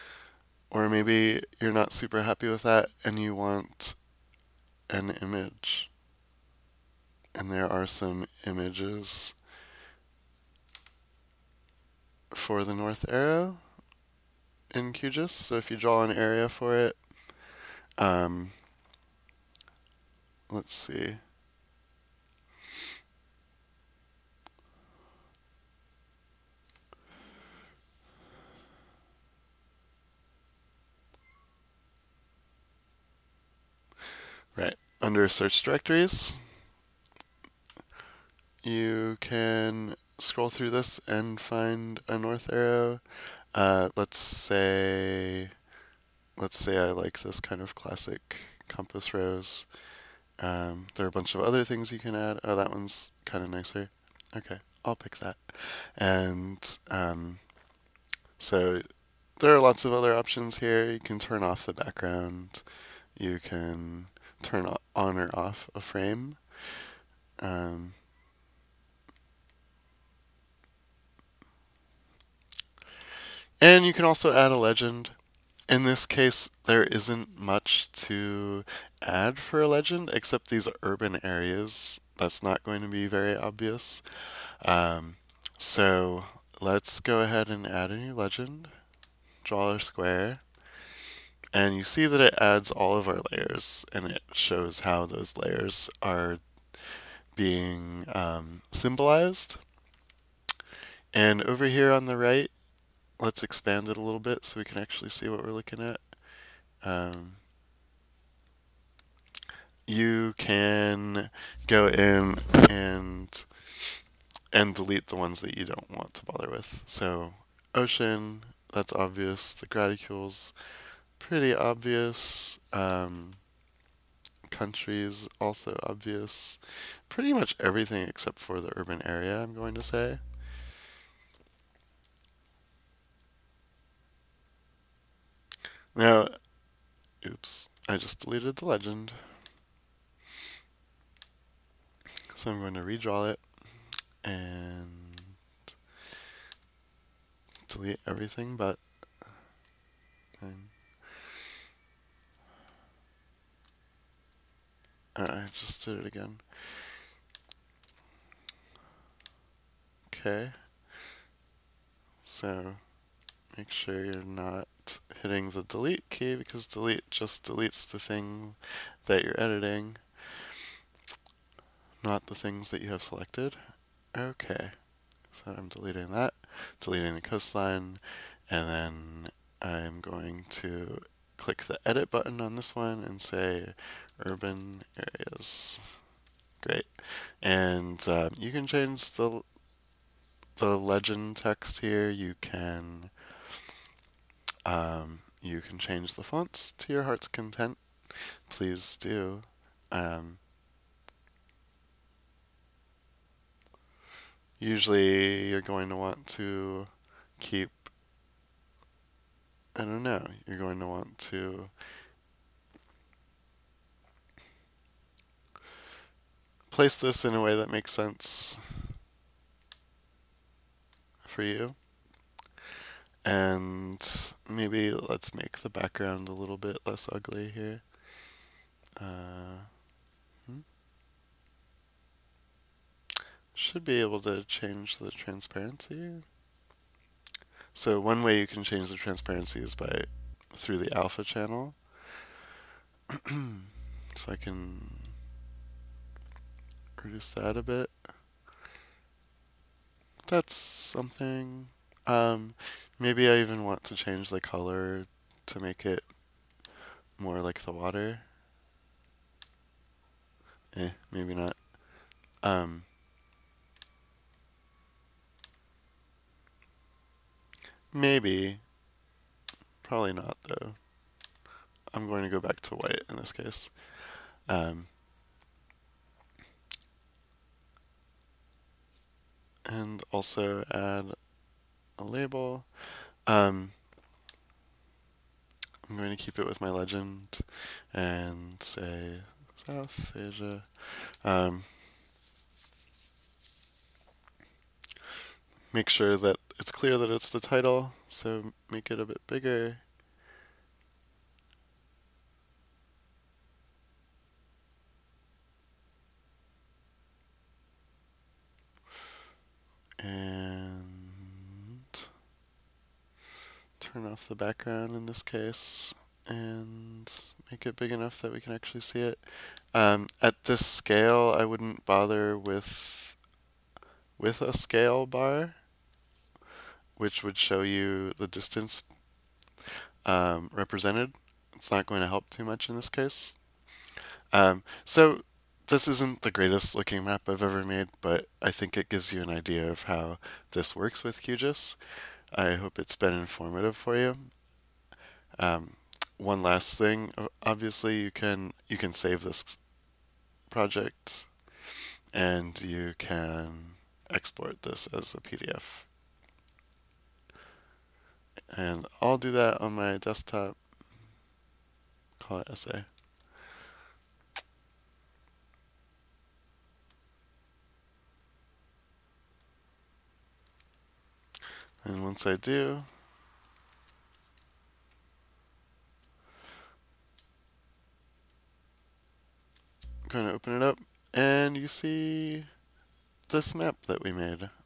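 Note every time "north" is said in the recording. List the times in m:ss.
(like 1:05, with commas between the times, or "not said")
0:12, 0:42.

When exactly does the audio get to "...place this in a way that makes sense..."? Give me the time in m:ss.
3:36.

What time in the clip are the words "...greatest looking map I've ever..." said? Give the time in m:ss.
5:36.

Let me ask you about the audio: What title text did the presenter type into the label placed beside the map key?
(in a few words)
South Asia.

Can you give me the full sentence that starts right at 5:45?
Um, one last thing, obviously you can you can save this project and you can export this as a PDF.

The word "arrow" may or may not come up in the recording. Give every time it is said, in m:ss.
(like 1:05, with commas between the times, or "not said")
0:13, 0:42.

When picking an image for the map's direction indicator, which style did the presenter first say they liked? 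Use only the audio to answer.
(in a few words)
classic compass rose.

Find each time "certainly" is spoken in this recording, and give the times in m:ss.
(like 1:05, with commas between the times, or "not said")
not said.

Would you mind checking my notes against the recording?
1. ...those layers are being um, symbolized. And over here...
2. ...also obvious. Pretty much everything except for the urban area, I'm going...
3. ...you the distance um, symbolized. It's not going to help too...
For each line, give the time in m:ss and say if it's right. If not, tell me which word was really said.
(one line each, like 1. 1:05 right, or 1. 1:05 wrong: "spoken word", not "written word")
1. 1:35 right
2. 2:05 right
3. 5:27 wrong: "represented", not "symbolized".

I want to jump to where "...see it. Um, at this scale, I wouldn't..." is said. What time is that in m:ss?
5:18.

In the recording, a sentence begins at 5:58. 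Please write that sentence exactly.
And I'll do that on my desktop, call it essay.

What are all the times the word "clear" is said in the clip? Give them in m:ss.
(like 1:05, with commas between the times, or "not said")
4:56.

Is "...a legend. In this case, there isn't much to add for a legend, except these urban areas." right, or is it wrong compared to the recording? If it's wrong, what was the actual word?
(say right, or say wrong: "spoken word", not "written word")
right.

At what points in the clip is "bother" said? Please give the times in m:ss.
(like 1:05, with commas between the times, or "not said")
1:56, 5:21.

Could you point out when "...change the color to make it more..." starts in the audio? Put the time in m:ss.
4:13.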